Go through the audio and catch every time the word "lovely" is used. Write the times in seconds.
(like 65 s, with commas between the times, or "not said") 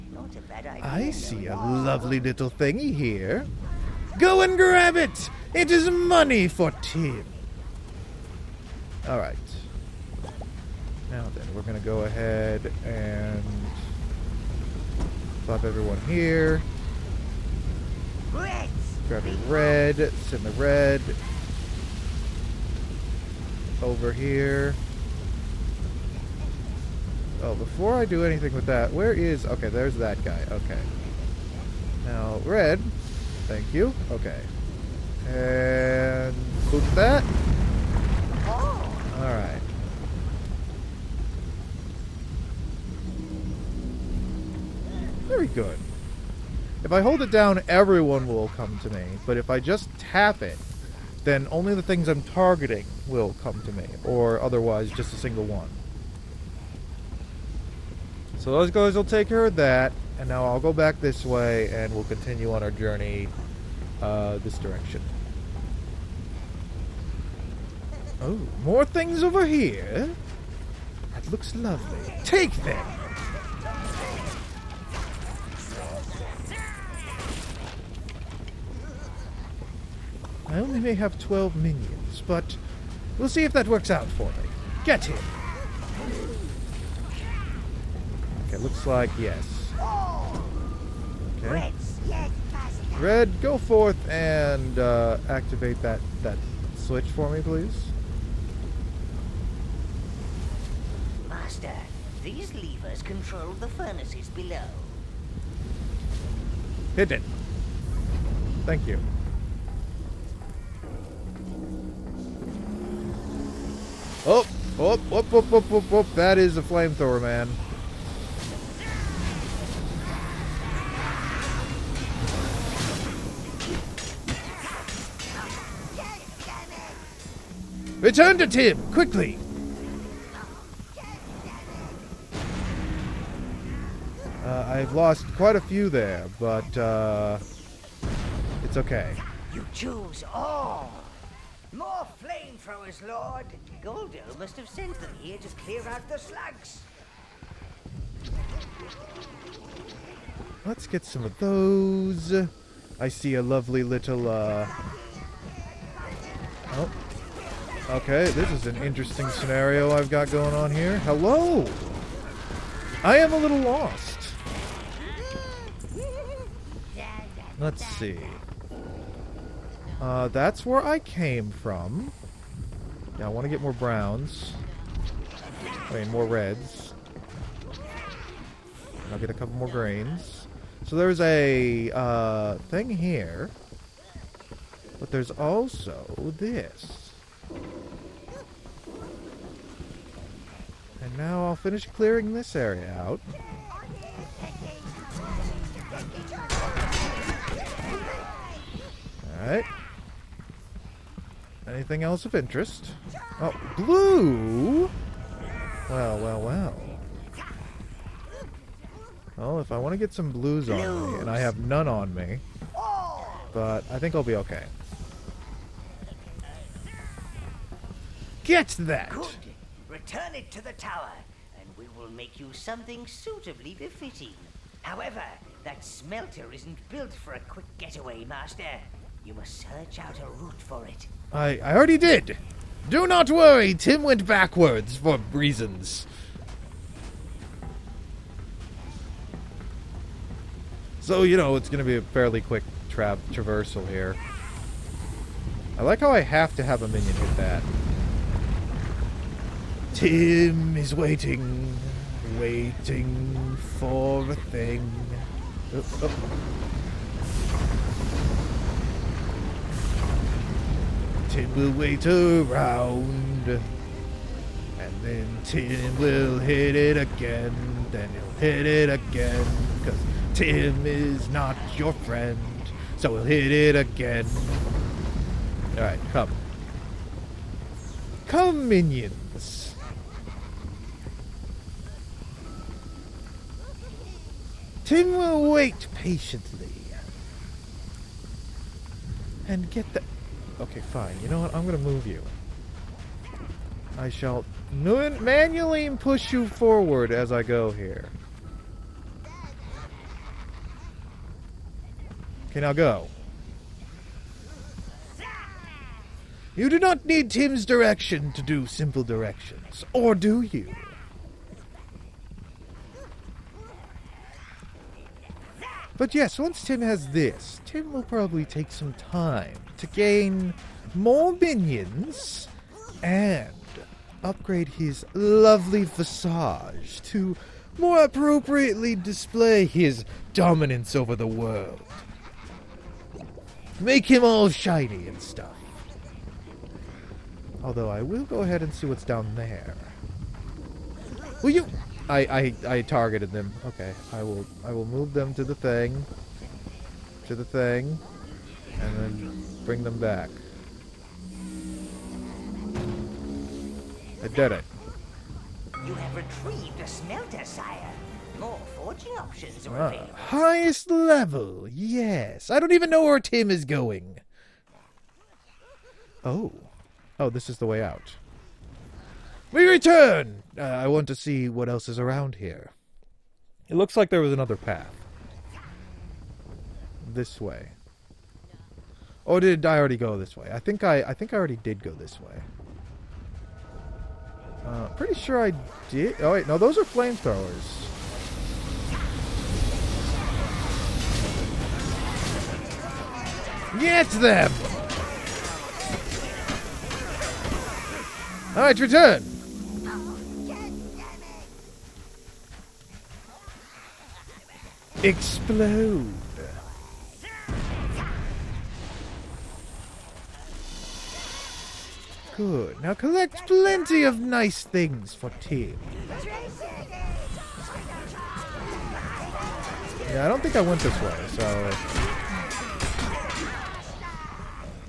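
1 s, 71 s, 153 s, 325 s.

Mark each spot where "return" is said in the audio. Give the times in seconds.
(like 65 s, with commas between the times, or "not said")
128 s, 219 s, 369 s, 398 s.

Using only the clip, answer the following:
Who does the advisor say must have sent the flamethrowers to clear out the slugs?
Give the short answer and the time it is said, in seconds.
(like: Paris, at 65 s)
Goldo, at 143 s.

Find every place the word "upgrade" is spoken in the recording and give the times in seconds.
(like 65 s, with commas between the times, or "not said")
324 s.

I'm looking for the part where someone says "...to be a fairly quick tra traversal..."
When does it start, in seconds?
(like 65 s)
241 s.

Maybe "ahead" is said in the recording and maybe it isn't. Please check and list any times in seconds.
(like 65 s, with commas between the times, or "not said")
12 s, 338 s.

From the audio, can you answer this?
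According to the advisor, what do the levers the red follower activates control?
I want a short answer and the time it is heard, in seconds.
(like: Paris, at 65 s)
The furnaces below, at 103 s.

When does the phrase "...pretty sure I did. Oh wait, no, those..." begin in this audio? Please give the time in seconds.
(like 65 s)
384 s.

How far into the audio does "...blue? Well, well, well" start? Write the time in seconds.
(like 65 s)
203 s.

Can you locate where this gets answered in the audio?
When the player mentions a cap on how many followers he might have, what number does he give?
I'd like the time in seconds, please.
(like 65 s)
81 s.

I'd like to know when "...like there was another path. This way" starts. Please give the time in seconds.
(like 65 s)
373 s.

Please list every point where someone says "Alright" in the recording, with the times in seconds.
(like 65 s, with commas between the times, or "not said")
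9 s, 39 s, 199 s, 275 s, 398 s.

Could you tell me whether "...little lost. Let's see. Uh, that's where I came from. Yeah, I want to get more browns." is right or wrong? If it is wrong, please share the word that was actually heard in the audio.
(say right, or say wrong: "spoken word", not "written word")
right.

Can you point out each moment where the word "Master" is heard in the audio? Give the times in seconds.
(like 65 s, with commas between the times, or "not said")
101 s, 228 s.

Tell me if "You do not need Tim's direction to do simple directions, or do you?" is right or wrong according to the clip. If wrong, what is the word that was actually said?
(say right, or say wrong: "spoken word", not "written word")
right.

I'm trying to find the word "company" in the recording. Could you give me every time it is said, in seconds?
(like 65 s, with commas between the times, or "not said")
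not said.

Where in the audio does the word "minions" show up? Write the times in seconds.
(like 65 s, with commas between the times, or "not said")
81 s, 246 s, 278 s, 321 s.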